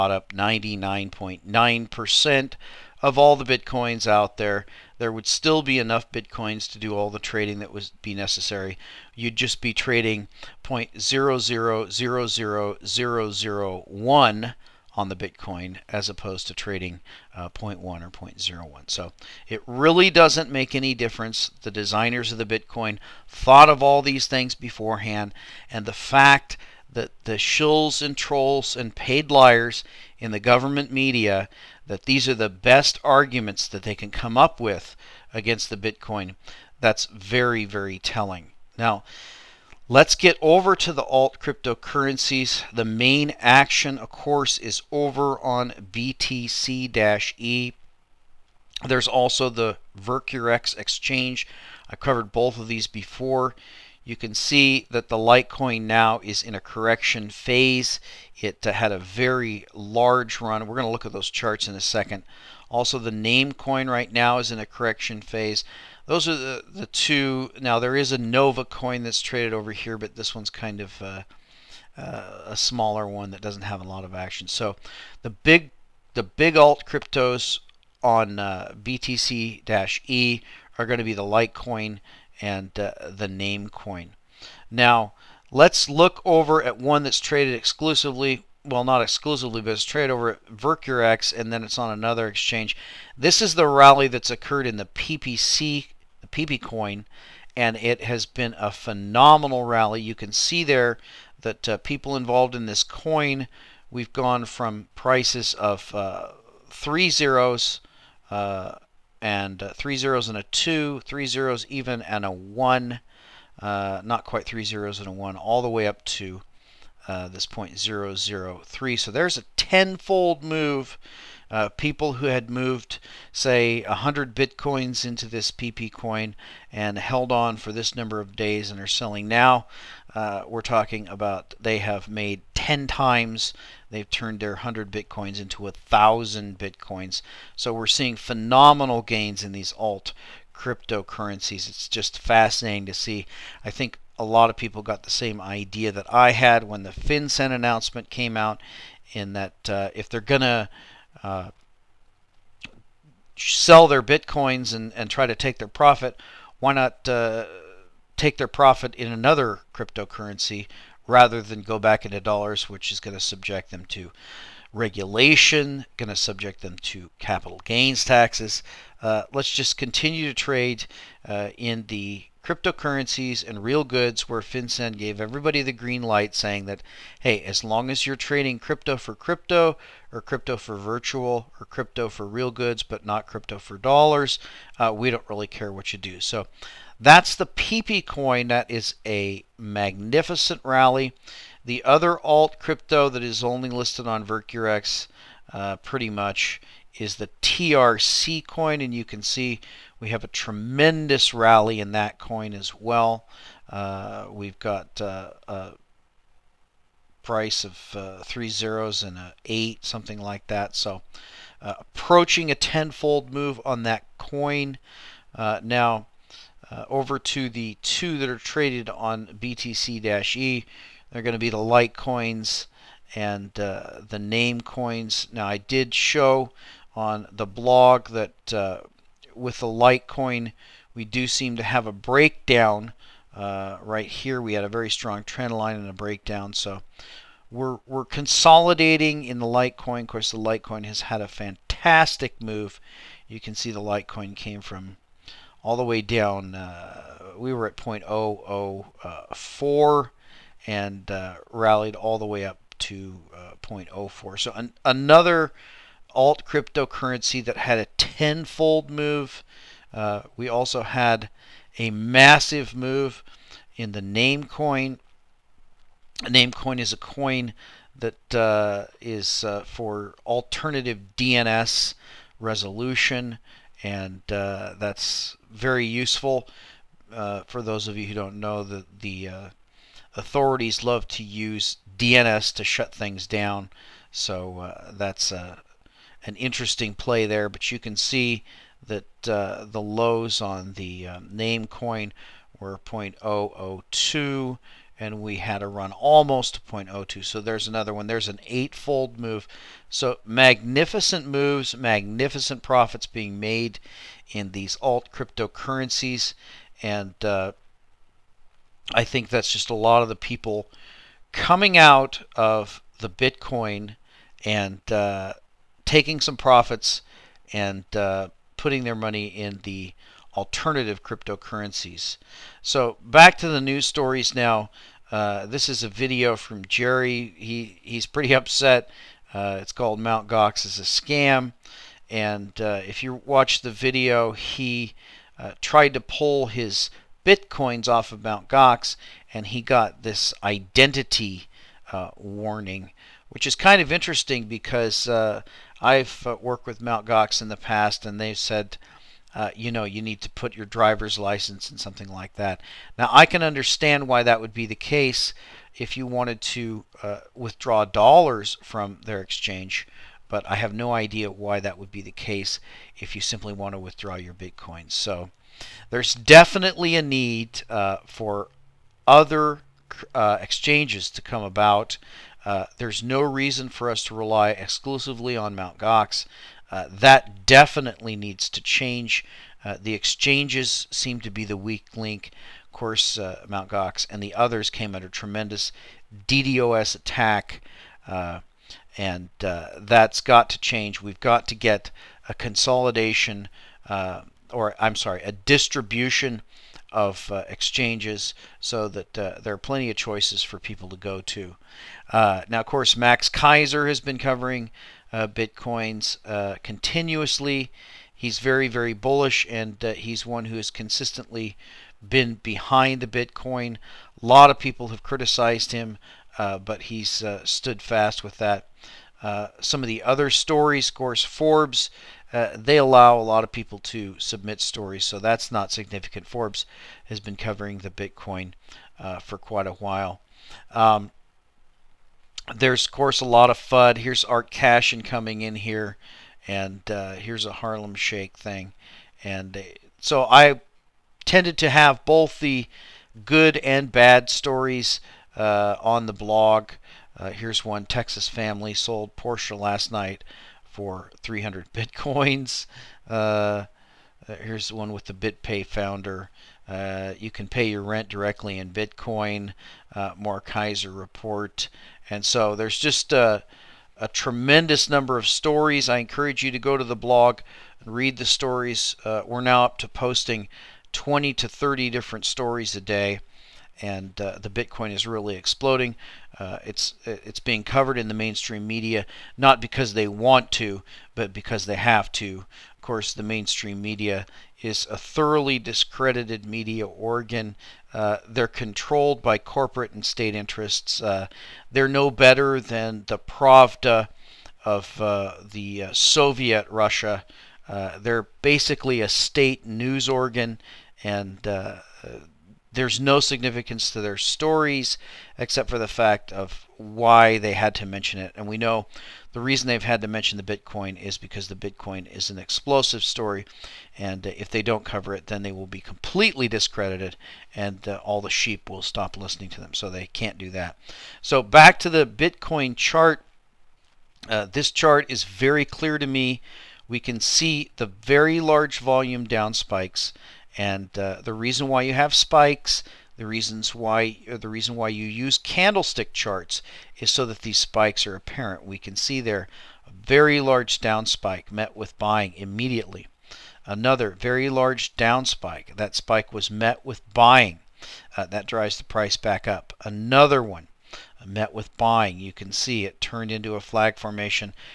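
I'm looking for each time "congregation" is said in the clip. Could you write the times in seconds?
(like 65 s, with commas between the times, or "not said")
not said.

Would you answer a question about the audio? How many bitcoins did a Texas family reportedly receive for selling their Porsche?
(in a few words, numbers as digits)
300.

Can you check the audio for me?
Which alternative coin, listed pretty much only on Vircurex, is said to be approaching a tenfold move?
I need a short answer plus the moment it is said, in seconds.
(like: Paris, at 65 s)
TRC coin, at 197 s.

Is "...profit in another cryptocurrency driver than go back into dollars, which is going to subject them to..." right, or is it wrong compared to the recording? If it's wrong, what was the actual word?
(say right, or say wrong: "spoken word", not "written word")
wrong: "rather", not "driver".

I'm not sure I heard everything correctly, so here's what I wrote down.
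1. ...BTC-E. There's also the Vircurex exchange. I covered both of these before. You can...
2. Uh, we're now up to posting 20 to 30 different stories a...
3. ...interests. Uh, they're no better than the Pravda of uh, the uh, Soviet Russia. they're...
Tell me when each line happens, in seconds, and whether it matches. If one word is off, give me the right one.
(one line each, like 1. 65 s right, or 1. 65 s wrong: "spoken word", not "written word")
1. 45 s right
2. 469 s right
3. 490 s right.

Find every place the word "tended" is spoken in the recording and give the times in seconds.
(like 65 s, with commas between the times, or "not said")
441 s.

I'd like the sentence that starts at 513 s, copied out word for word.
And if they don't cover it, then they will be completely discredited and uh, all the sheep will stop listening to them.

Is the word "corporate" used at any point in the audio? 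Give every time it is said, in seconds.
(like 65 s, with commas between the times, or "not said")
489 s.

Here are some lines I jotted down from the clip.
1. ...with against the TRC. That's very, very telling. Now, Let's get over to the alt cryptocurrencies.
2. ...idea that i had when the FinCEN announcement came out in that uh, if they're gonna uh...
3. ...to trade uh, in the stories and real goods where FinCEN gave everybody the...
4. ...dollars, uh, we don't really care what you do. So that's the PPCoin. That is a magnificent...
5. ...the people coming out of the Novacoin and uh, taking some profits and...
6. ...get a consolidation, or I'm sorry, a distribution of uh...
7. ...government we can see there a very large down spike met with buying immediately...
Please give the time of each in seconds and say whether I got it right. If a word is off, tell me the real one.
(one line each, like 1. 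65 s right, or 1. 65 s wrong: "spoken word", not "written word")
1. 34 s wrong: "Bitcoin", not "TRC"
2. 145 s right
3. 170 s wrong: "cryptocurrencies", not "stories"
4. 183 s right
5. 310 s wrong: "Bitcoin", not "Novacoin"
6. 391 s right
7. 538 s wrong: "apparent", not "government".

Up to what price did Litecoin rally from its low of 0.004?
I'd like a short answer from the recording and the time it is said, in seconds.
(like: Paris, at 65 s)
0.04, at 253 s.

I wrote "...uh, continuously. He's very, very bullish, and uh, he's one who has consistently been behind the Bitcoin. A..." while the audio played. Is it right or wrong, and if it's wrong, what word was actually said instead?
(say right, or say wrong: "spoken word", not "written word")
right.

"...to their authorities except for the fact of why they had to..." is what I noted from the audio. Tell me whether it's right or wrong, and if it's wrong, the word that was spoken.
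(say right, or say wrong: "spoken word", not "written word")
wrong: "stories", not "authorities".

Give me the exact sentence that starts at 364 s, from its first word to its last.
So there's definitely a need uh, for other uh, exchanges to come about.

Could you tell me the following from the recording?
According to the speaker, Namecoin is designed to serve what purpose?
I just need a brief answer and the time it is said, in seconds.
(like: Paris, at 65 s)
alternative DNS resolution, at 270 s.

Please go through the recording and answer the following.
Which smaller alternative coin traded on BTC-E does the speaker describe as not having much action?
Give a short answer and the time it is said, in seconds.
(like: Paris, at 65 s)
Novacoin, at 68 s.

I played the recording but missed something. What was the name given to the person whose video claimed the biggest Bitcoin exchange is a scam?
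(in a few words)
Jerry.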